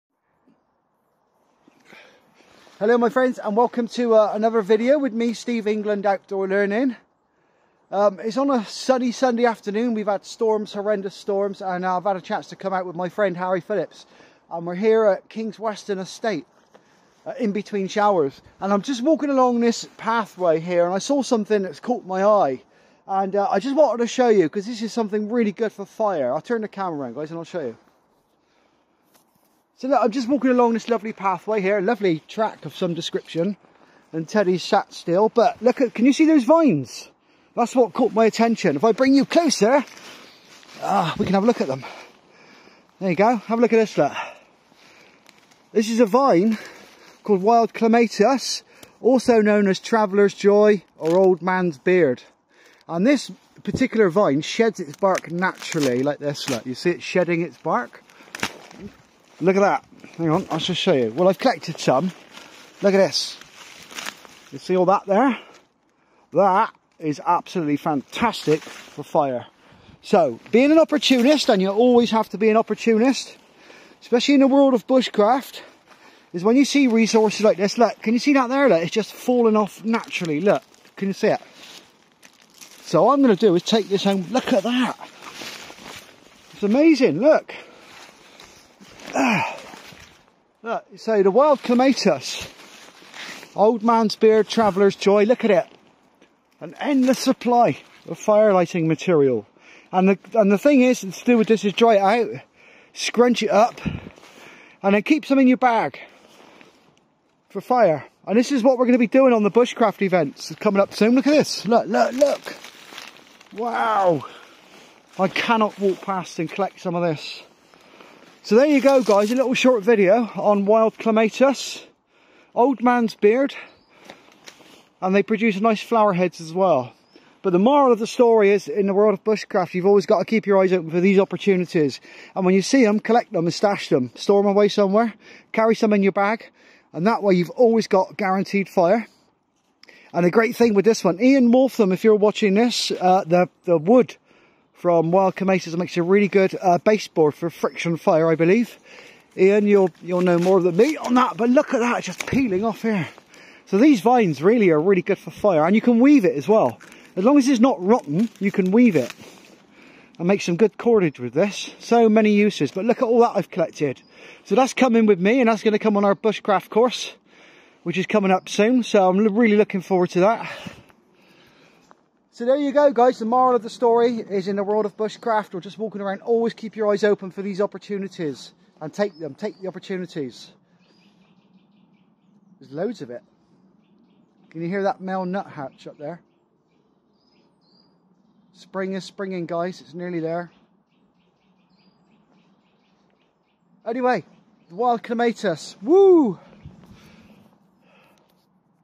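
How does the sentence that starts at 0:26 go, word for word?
I'll turn the camera around guys and I'll show you.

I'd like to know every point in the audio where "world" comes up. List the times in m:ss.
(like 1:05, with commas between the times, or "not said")
1:14, 2:08, 2:54.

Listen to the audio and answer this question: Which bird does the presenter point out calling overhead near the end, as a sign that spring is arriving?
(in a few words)
Male nuthatch.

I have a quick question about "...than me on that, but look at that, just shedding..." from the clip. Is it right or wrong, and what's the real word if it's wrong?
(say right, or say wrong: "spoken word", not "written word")
wrong: "peeling", not "shedding".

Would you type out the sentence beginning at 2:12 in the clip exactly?
And when you see them, collect them and stash them.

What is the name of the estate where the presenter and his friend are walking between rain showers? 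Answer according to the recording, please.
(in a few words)
King's Weston Estate.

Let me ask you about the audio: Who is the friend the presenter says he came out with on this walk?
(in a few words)
Harry Phillips.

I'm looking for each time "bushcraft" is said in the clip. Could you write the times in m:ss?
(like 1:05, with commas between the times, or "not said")
1:14, 1:49, 2:09, 2:46, 2:54.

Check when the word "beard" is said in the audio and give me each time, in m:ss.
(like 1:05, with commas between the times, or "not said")
0:51, 1:34, 2:03.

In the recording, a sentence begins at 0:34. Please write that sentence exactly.
And Teddy's sat still, but look at, can you see those vines?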